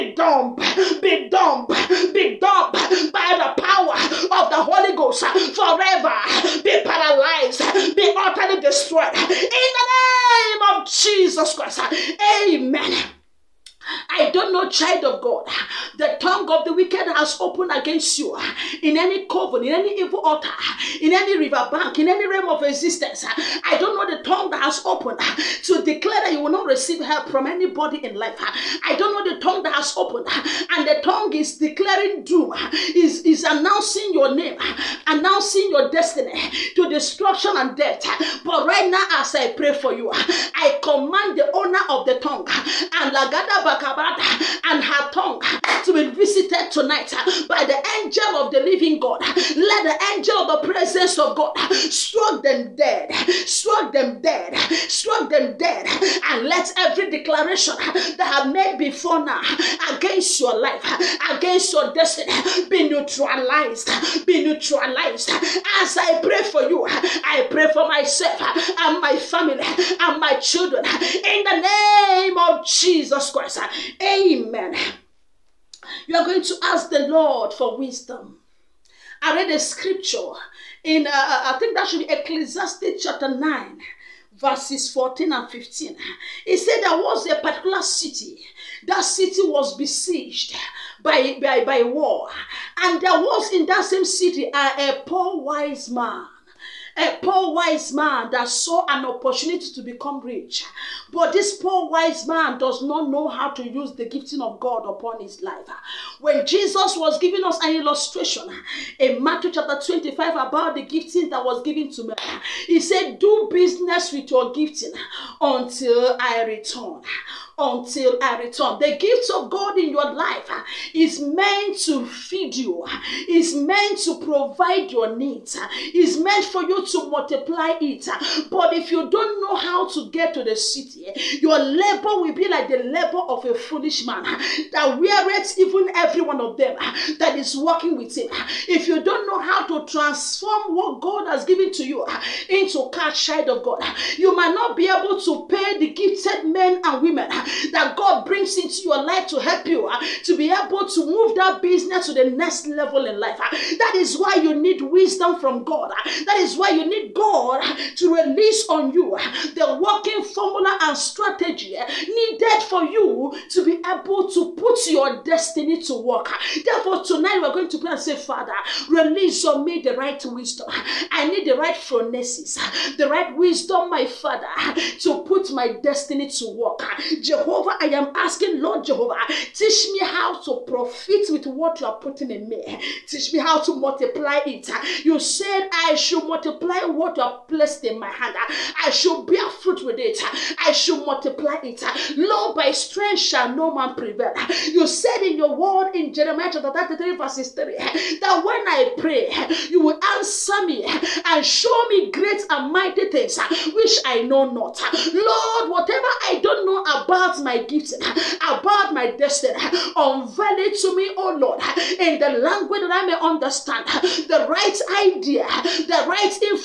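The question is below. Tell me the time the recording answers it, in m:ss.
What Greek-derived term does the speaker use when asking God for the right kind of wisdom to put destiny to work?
2:51.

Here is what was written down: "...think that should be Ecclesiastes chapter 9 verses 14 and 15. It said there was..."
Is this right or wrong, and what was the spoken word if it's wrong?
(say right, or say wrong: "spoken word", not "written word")
right.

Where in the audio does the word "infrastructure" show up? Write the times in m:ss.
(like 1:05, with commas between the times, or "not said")
not said.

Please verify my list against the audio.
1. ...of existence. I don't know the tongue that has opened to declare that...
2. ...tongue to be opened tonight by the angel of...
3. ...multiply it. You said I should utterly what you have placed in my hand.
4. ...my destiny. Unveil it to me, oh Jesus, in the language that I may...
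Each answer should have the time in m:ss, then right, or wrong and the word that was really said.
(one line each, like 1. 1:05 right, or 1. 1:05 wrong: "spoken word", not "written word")
1. 0:22 right
2. 0:45 wrong: "visited", not "opened"
3. 3:03 wrong: "multiply", not "utterly"
4. 3:28 wrong: "Lord", not "Jesus".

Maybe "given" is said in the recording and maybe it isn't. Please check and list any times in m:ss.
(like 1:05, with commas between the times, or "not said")
1:51, 2:21.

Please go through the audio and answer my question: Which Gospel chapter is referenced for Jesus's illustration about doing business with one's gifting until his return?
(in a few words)
Matthew 25.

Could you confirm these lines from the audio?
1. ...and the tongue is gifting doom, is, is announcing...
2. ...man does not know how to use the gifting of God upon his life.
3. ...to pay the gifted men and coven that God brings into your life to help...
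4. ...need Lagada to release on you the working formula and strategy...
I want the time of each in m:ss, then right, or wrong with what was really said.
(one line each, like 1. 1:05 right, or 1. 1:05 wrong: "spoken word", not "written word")
1. 0:30 wrong: "declaring", not "gifting"
2. 1:42 right
3. 2:25 wrong: "women", not "coven"
4. 2:36 wrong: "God", not "Lagada".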